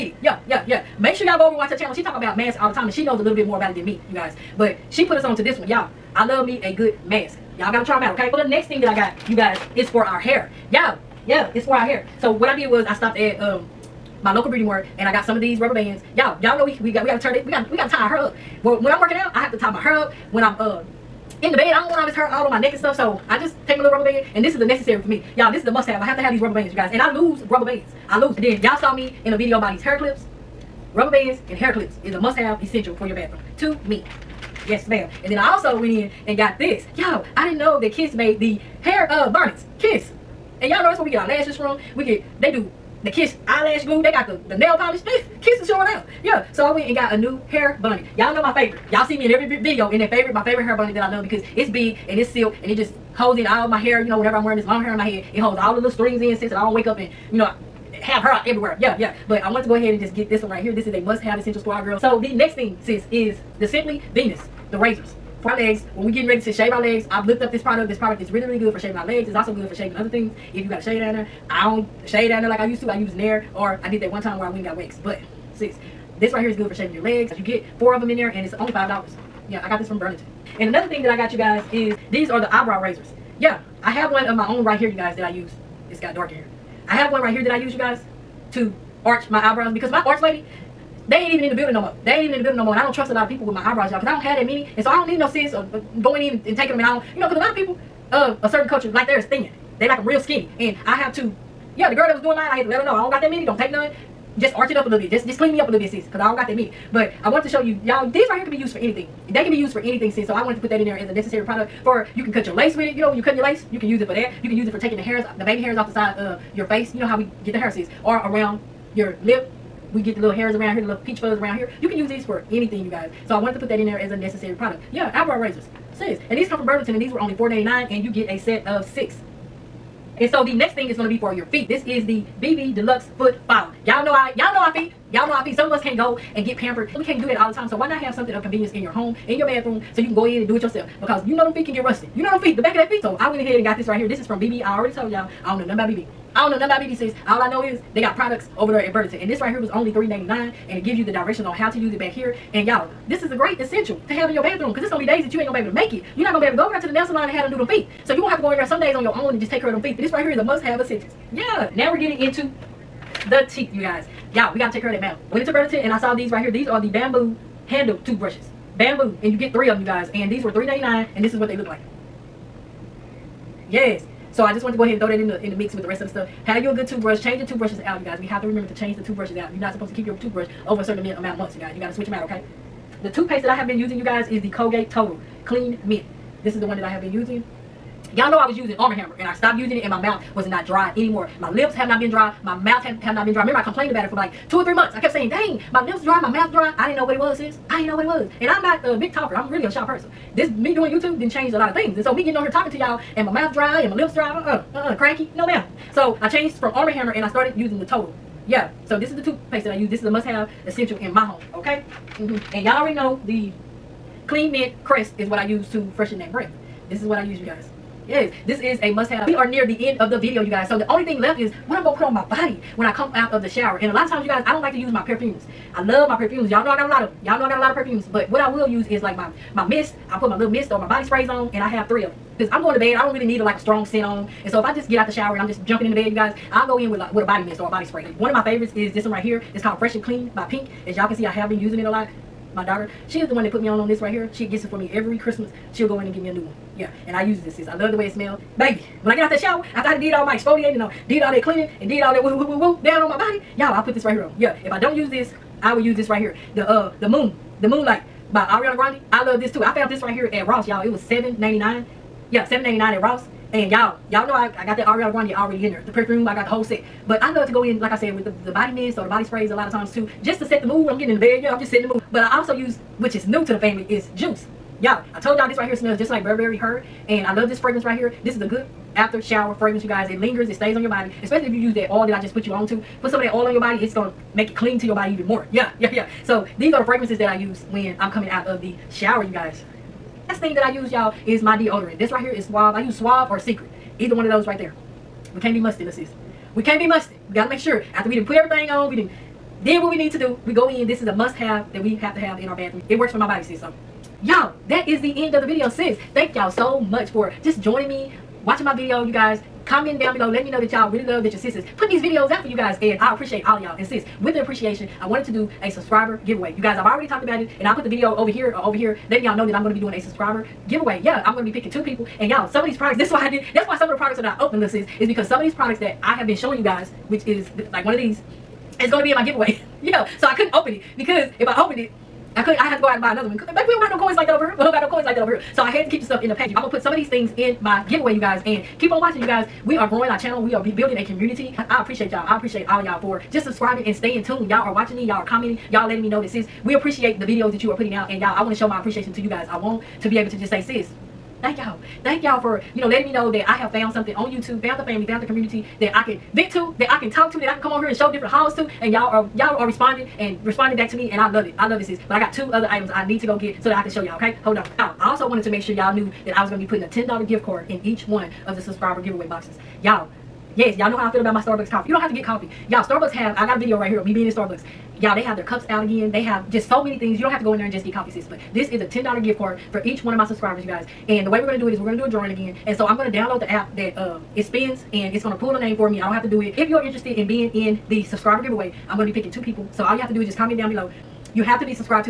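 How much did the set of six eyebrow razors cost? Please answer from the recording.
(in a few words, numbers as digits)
$4.99.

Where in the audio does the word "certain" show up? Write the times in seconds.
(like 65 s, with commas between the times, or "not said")
98 s, 180 s.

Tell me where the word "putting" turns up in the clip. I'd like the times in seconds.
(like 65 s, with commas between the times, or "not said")
311 s, 347 s, 366 s.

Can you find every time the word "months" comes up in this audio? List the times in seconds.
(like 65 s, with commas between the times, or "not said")
181 s, 194 s.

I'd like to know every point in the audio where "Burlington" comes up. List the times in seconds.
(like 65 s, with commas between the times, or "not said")
79 s, 126 s, 148 s, 165 s.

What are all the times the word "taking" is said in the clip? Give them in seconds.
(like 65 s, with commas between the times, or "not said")
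96 s, 114 s.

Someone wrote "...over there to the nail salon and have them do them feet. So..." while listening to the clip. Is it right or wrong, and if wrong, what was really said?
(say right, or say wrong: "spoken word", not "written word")
right.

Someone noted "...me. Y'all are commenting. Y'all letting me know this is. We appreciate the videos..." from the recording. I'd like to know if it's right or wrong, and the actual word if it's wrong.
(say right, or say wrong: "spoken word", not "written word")
right.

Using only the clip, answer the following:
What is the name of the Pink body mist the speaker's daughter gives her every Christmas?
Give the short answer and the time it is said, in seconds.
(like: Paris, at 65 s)
Fresh and Clean, at 239 s.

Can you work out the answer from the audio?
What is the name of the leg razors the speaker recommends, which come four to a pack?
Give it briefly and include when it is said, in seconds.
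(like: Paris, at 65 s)
Simply Venus, at 63 s.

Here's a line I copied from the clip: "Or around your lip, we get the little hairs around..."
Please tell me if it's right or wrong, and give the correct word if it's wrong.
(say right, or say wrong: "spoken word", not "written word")
right.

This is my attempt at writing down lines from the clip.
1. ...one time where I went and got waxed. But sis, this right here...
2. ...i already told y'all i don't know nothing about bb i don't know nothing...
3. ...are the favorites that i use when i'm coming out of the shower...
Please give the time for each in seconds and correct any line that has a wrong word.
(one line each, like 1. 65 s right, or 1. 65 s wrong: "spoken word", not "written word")
1. 74 s right
2. 144 s right
3. 286 s wrong: "fragrances", not "favorites".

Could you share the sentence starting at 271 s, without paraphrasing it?
Yeah, I'm just setting the mood.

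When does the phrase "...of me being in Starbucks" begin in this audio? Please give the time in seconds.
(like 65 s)
373 s.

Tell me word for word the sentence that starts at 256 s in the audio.
The uh the moon, the moonlight by Ariana Grande.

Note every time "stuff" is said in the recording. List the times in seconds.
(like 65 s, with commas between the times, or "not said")
22 s, 176 s, 336 s.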